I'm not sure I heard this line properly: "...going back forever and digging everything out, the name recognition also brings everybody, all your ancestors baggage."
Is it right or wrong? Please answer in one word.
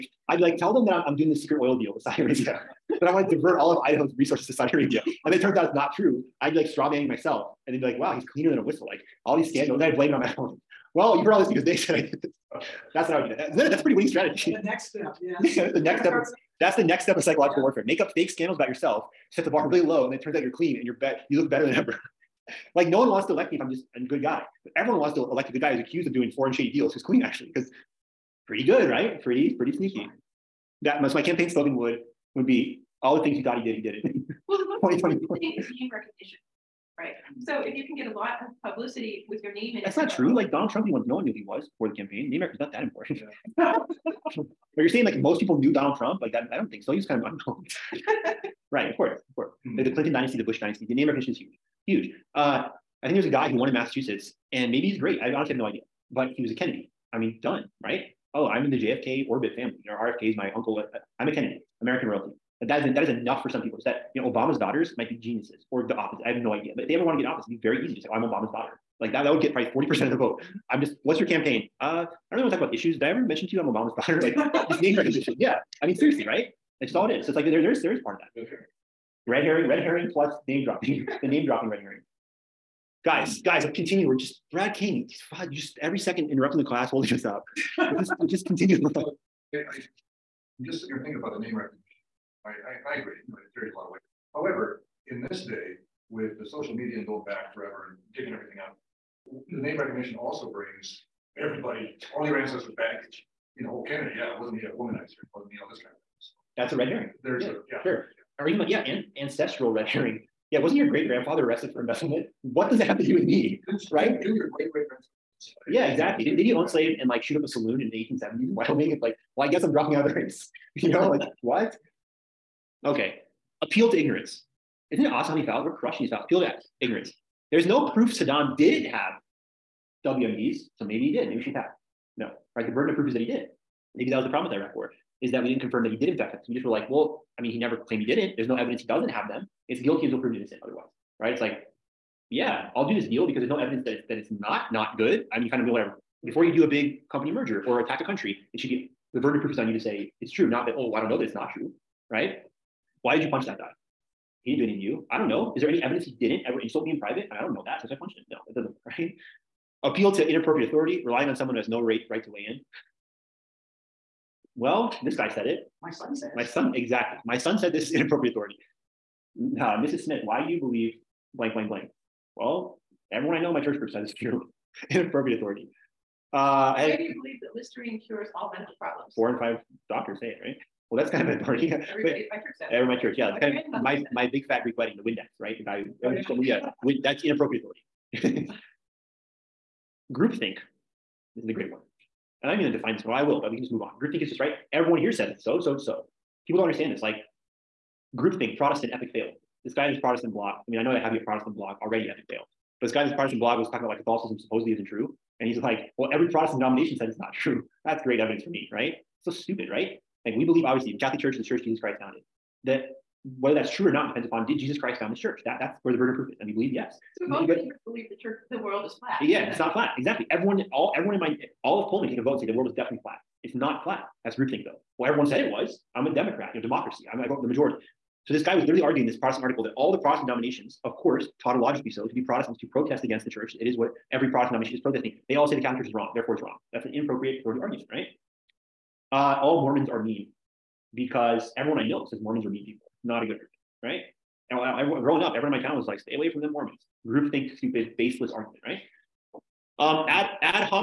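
right.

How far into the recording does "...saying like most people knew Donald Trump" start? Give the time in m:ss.
0:44.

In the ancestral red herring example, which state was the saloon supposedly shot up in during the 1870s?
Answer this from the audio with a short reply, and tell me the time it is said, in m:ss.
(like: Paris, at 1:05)
Wyoming, at 1:58.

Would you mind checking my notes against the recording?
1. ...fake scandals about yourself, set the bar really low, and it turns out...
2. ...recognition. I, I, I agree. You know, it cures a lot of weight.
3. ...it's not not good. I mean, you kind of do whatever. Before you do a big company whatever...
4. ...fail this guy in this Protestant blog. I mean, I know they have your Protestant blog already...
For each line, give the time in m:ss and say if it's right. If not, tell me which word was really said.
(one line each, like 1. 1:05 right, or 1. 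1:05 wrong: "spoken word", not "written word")
1. 0:18 right
2. 1:31 wrong: "carries", not "cures"
3. 2:24 wrong: "merger", not "whatever"
4. 3:19 right.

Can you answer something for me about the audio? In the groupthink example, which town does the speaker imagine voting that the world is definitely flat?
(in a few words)
Pullman.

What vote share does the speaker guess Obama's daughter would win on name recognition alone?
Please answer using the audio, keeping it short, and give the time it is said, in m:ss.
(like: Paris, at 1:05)
40%, at 1:09.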